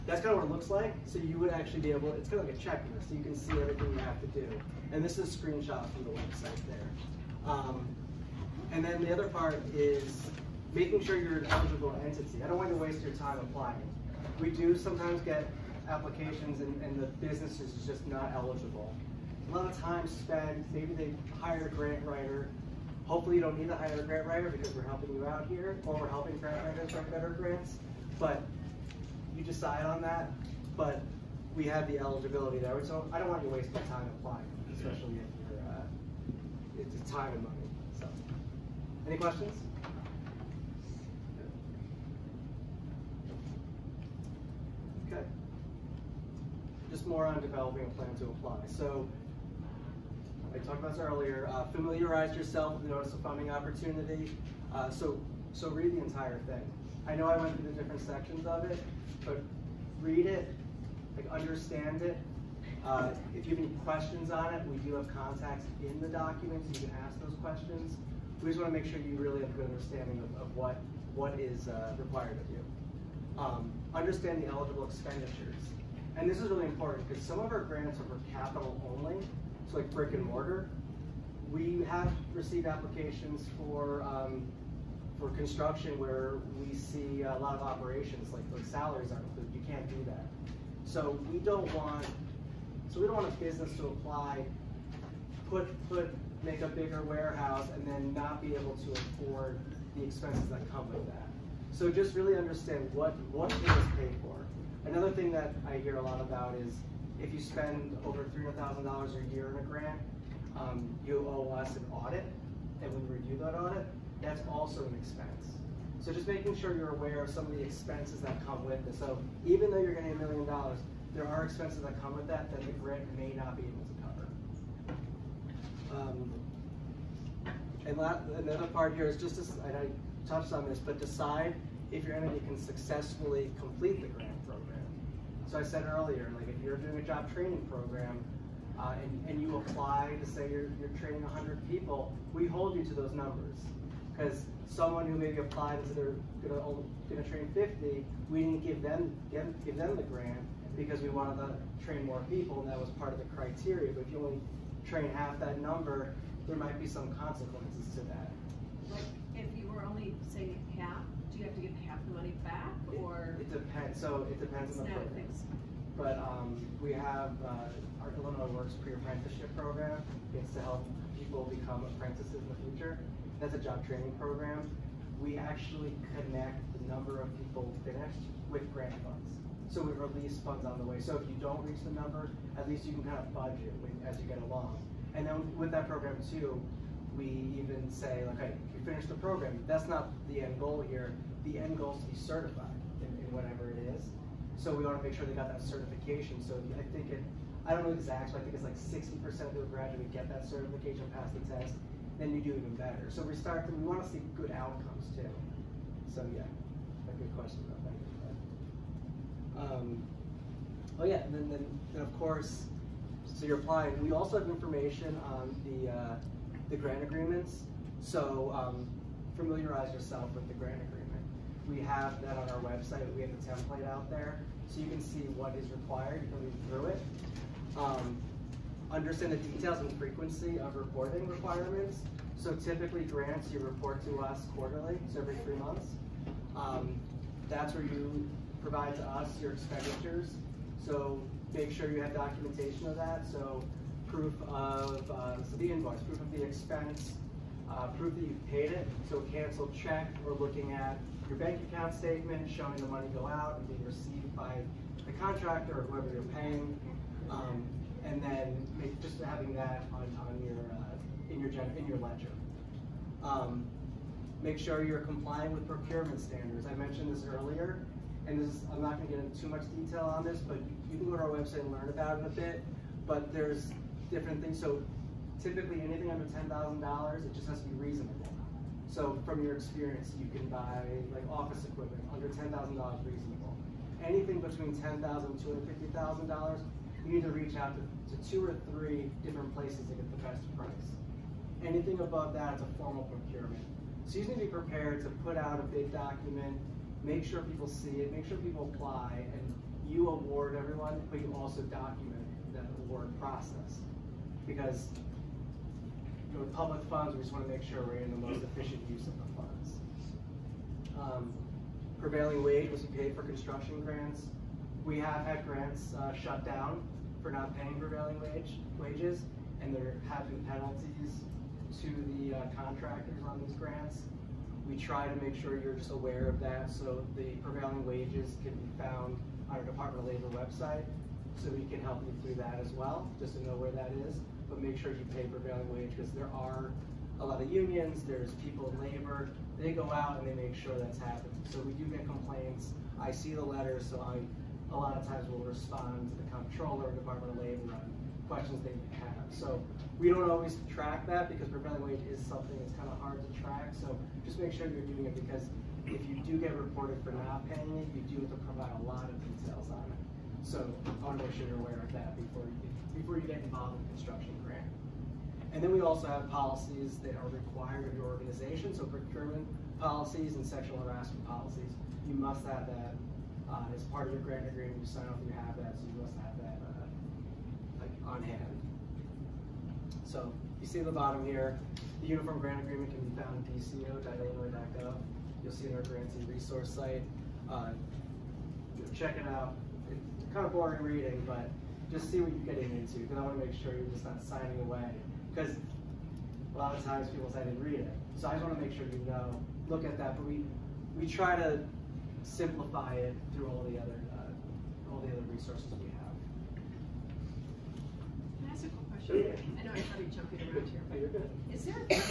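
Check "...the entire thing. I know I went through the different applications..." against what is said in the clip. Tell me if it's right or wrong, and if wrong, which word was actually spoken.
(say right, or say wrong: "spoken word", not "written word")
wrong: "sections", not "applications".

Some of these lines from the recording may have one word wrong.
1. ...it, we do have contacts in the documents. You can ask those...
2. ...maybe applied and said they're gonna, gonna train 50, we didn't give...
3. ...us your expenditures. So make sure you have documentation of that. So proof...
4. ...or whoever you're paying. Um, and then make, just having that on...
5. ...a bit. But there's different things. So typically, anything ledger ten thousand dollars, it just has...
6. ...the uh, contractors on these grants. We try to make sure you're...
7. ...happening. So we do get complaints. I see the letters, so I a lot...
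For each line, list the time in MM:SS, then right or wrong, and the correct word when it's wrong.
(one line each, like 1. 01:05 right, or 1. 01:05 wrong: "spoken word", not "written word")
1. 01:04 right
2. 02:25 right
3. 03:59 right
4. 04:15 right
5. 04:32 wrong: "under", not "ledger"
6. 05:22 right
7. 05:40 right.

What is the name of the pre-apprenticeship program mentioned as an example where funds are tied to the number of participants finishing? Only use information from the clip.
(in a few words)
Illinois Works.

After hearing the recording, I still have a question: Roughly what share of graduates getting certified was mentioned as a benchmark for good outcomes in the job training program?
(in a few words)
60%.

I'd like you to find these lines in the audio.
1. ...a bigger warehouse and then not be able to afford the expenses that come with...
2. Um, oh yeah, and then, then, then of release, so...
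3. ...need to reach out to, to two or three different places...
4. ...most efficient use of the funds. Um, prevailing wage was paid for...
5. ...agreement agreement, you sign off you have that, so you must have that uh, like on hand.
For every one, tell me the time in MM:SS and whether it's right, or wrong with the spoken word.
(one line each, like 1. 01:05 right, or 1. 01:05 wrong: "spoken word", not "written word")
1. 01:36 right
2. 03:29 wrong: "course", not "release"
3. 04:47 right
4. 05:08 right
5. 06:14 wrong: "grant", not "agreement".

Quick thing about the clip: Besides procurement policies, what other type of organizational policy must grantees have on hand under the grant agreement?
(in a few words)
Sexual harassment policies.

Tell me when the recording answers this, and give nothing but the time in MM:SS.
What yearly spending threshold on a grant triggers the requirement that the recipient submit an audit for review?
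01:48.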